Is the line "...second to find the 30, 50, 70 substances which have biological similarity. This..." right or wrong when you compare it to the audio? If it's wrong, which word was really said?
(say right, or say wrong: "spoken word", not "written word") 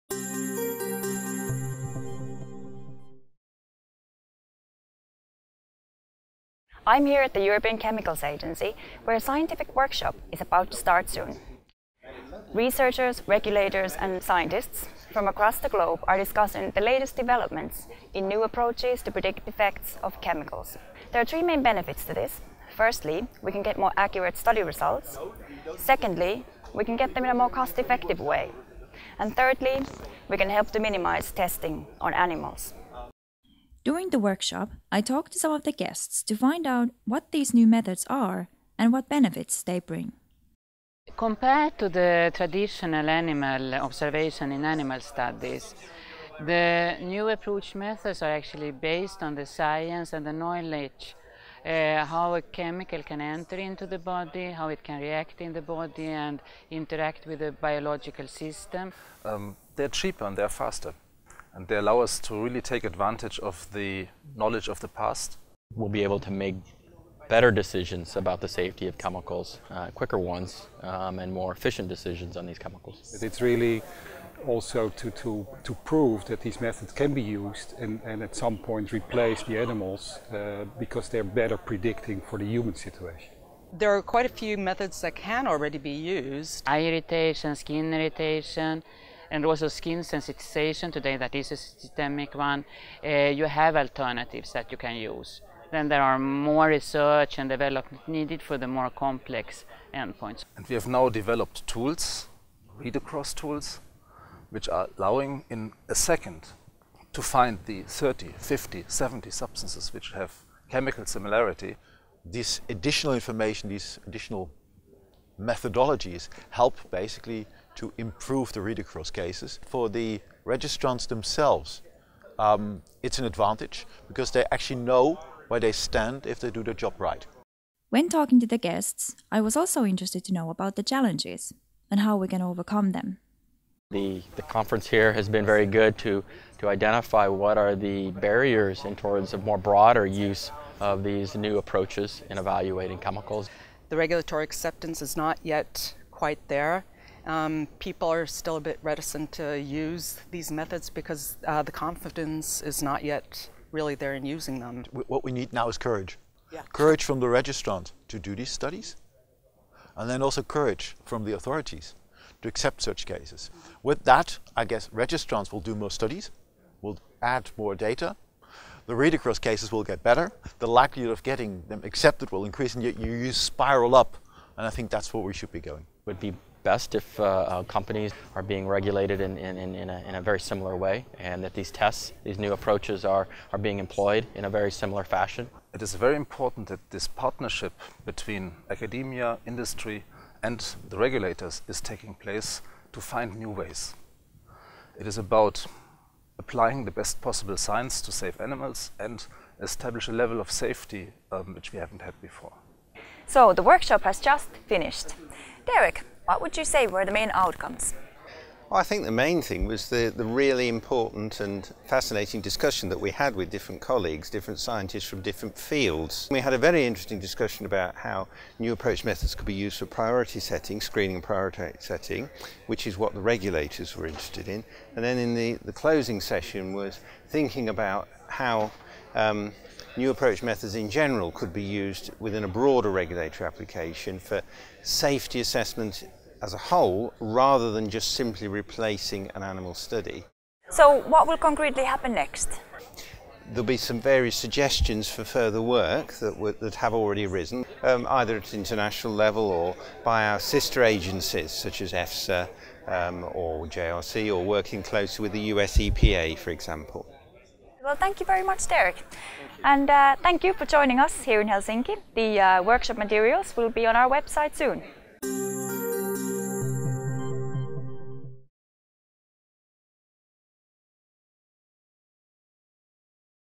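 wrong: "chemical", not "biological".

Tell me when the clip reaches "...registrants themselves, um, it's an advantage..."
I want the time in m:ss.
2:00.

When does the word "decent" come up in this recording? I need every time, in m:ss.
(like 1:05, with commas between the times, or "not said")
not said.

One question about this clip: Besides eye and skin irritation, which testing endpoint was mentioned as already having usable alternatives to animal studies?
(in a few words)
skin sensitization.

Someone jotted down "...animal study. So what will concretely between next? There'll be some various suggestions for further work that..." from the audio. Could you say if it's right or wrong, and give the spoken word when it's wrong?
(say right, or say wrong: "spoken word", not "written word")
wrong: "happen", not "between".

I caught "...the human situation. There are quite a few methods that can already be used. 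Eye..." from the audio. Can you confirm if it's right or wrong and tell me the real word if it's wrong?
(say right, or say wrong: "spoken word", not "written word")
right.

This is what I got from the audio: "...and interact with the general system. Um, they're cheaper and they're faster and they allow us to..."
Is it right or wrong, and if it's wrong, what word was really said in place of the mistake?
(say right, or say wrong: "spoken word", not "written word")
wrong: "biological", not "general".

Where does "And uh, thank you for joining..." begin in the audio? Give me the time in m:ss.
4:19.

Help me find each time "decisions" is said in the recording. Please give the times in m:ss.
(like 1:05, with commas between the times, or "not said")
1:07, 1:11.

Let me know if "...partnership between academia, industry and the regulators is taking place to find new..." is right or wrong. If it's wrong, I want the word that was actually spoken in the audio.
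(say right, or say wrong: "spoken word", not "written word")
right.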